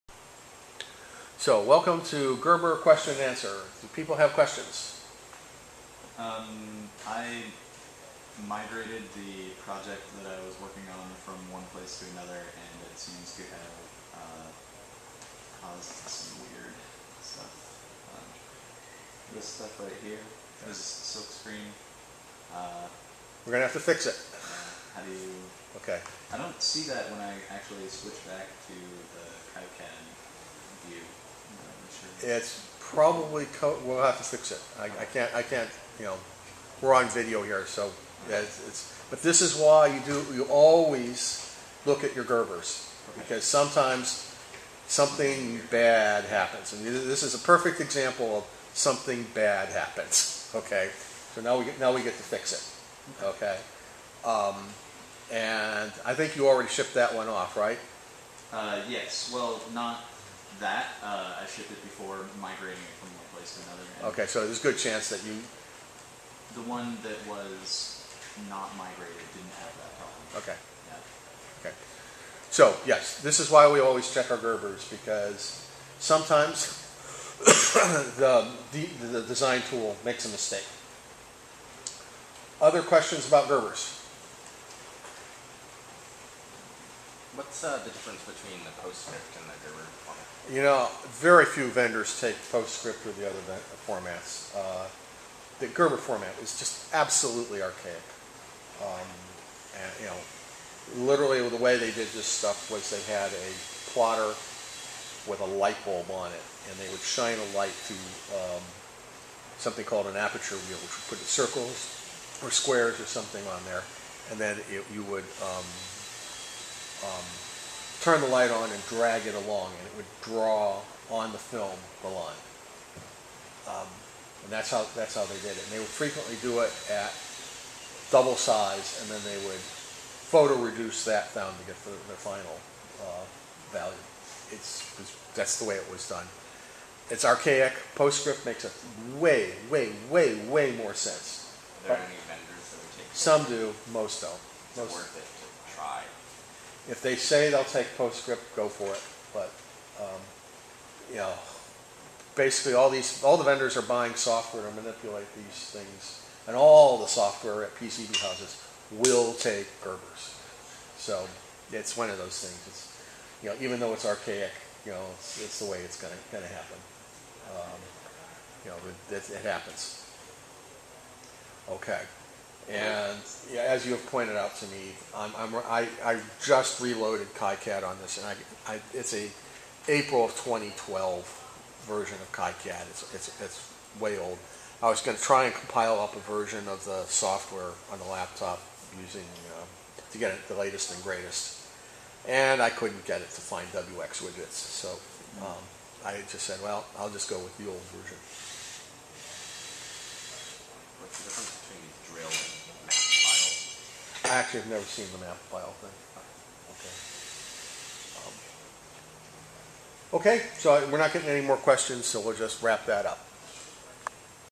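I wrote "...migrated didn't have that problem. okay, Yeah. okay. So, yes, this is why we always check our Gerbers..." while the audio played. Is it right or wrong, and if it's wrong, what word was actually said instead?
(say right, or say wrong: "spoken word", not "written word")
right.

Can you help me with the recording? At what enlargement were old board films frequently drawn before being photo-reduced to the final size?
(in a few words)
double size.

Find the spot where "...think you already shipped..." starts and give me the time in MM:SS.
00:56.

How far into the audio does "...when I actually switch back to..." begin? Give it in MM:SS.
00:27.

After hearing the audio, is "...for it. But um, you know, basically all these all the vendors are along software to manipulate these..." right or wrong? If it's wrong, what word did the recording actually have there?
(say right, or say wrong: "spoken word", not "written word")
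wrong: "buying", not "along".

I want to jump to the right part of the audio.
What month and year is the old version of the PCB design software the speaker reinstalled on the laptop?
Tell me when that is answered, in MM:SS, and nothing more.
02:59.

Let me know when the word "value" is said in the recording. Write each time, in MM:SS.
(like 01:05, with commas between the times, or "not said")
02:13.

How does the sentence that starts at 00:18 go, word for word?
Um, this stuff right here, this silk screen.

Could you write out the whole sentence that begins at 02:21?
Are there but any vendors that would take?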